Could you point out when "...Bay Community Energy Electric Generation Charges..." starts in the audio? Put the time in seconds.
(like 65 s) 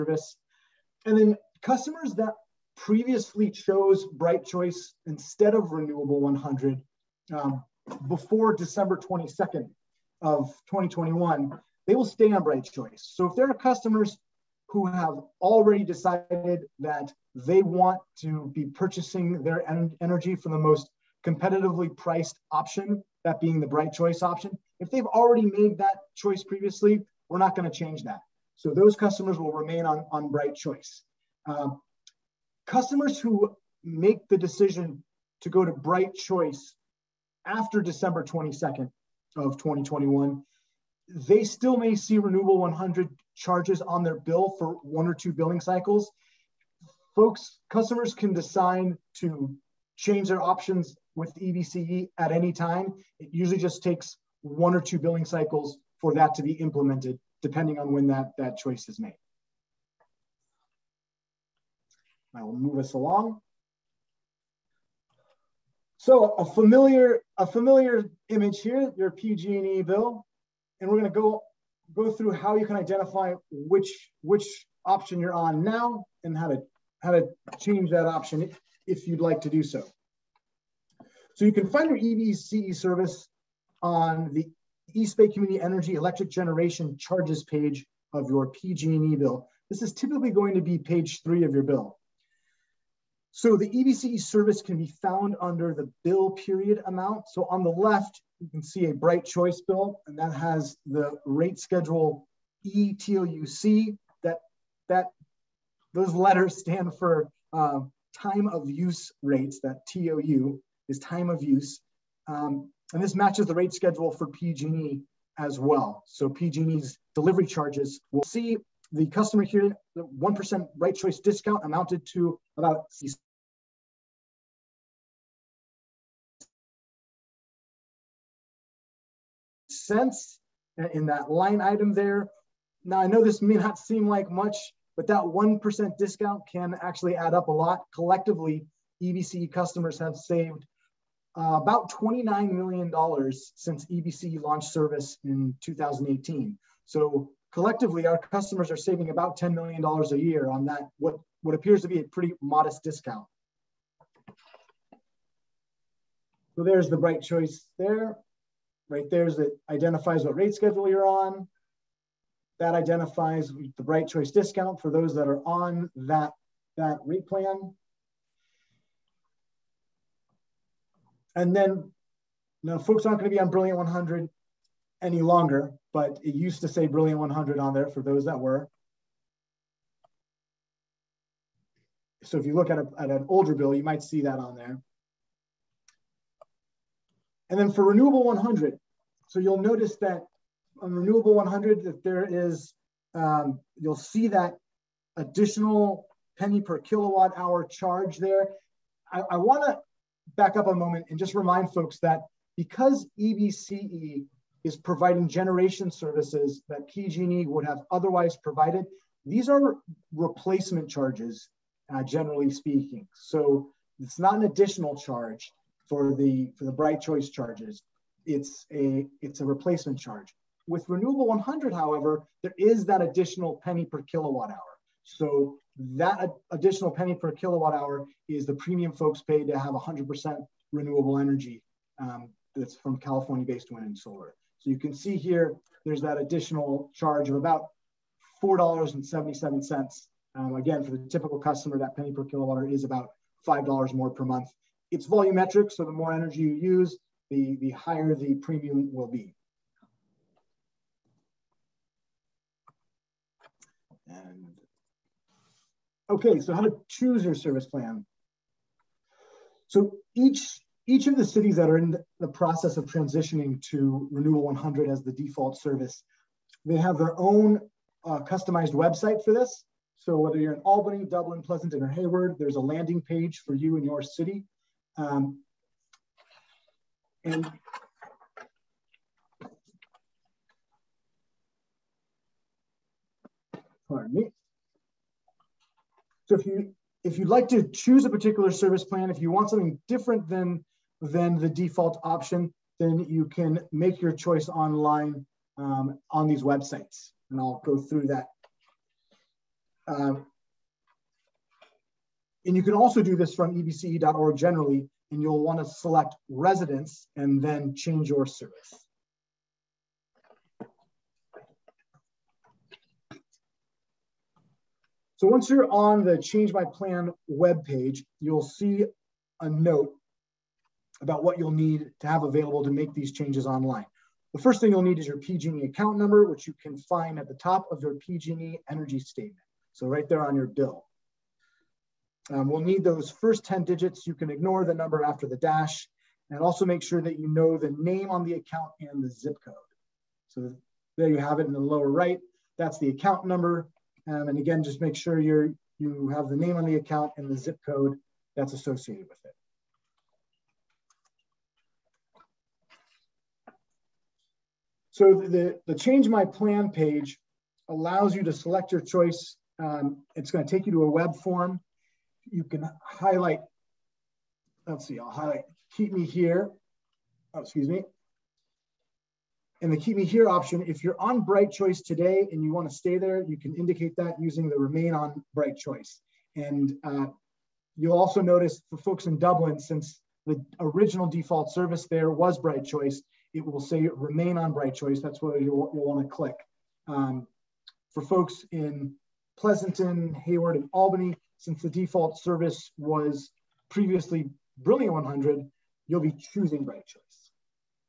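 85 s.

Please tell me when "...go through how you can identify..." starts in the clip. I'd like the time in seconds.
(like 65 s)
71 s.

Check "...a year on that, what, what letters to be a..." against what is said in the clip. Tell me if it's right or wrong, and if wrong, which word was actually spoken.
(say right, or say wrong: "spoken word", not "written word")
wrong: "appears", not "letters".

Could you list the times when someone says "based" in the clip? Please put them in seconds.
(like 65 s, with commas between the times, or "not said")
232 s.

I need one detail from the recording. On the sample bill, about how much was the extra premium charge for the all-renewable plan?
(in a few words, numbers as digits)
$4.77.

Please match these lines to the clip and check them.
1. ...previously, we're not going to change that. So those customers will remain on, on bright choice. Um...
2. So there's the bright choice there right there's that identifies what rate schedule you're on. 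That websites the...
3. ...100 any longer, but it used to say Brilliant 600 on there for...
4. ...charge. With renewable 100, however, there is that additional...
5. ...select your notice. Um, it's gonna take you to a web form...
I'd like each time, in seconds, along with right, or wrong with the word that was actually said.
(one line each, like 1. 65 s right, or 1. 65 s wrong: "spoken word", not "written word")
1. 26 s right
2. 156 s wrong: "identifies", not "websites"
3. 173 s wrong: "100", not "600"
4. 219 s right
5. 358 s wrong: "choice", not "notice".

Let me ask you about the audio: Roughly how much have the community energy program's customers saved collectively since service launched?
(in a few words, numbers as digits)
$29 million.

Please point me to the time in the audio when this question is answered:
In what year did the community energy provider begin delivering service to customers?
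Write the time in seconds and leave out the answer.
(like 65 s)
145 s.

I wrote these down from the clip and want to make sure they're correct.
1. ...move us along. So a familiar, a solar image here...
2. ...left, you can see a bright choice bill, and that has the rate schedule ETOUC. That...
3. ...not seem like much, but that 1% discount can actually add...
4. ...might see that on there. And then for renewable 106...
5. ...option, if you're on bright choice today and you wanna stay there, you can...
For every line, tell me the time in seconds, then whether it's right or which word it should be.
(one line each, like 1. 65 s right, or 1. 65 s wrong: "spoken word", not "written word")
1. 62 s wrong: "familiar", not "solar"
2. 97 s right
3. 133 s right
4. 183 s wrong: "100", not "106"
5. 370 s right.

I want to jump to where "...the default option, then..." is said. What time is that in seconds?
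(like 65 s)
291 s.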